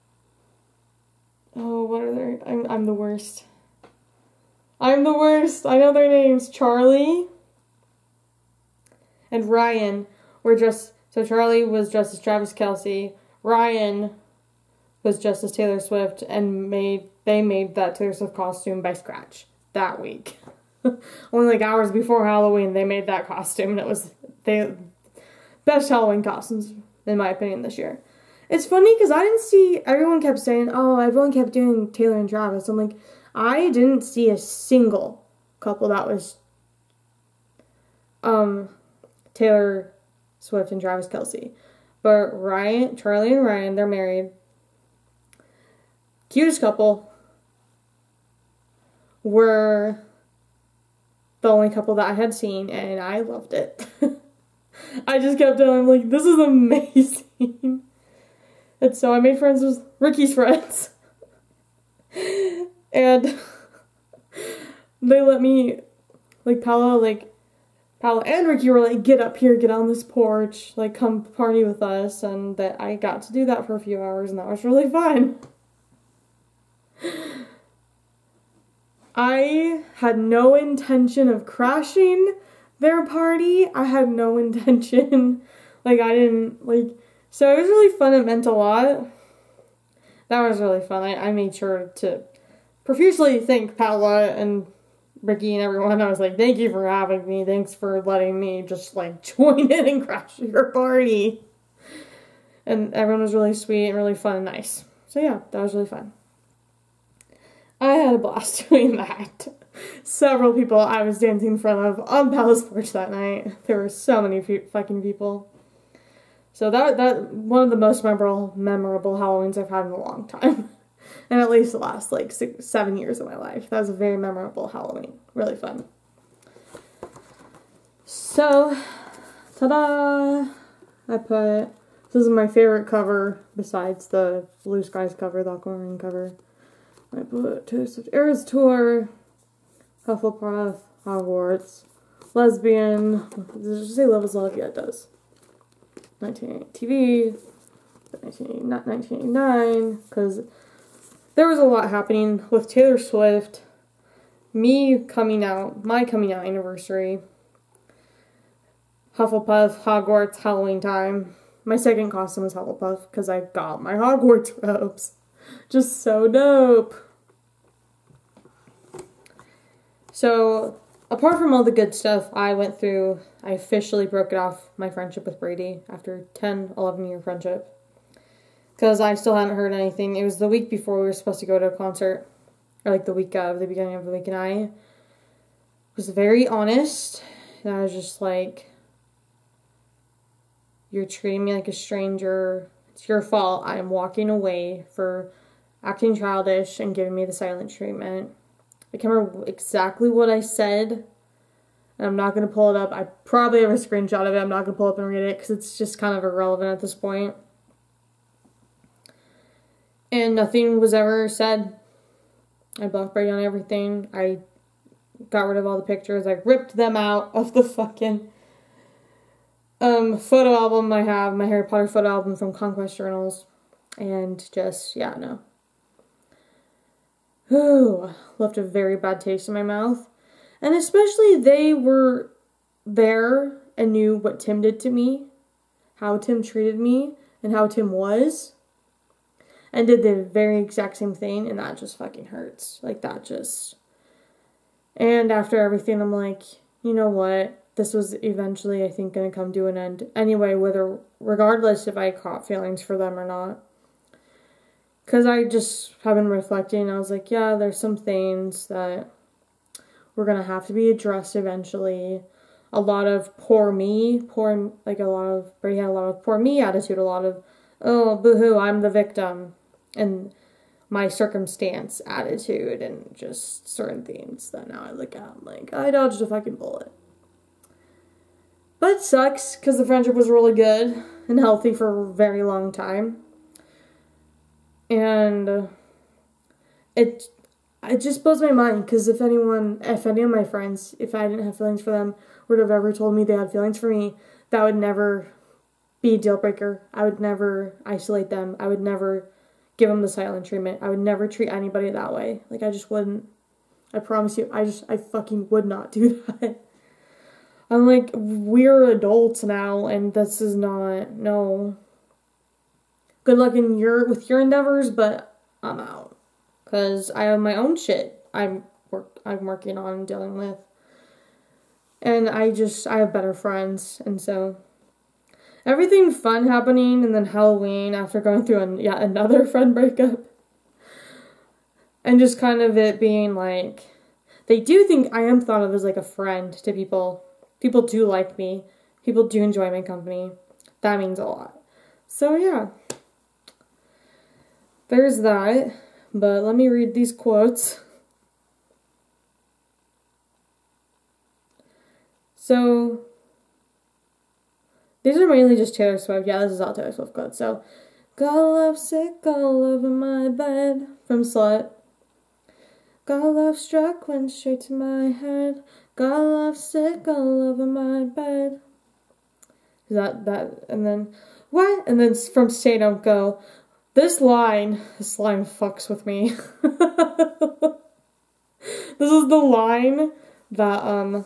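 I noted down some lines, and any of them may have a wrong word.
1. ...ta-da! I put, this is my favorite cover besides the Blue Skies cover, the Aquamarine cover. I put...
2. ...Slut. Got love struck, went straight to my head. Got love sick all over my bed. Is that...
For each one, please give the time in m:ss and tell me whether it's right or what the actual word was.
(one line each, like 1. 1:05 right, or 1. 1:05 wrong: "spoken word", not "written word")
1. 2:09 right
2. 6:01 right.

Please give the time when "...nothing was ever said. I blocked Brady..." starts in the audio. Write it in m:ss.
3:30.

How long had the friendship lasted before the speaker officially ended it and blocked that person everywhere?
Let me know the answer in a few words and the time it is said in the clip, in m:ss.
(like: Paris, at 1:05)
10 or 11 years, at 2:56.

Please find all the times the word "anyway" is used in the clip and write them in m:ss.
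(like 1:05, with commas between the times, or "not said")
4:10.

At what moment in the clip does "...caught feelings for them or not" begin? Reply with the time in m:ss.
4:12.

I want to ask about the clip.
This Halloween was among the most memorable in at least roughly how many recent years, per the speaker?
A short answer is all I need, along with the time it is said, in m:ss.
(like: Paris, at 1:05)
6 or 7 years, at 2:02.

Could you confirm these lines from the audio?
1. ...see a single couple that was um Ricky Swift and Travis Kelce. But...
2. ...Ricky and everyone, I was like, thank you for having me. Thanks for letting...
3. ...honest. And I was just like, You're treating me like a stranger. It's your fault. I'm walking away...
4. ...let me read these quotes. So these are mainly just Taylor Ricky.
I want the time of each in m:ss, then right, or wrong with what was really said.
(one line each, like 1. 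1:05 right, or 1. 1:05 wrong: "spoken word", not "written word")
1. 0:34 wrong: "Taylor", not "Ricky"
2. 1:35 right
3. 3:06 right
4. 5:46 wrong: "Swift", not "Ricky".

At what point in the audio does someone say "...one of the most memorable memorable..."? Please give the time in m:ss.
1:57.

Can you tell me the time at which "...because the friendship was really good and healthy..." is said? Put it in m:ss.
4:39.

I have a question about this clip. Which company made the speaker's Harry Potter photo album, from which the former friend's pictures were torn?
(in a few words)
Conquest Journals.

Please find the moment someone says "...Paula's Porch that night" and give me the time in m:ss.
1:52.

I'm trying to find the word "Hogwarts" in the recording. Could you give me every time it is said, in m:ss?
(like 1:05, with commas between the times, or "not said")
2:21, 2:39, 2:43.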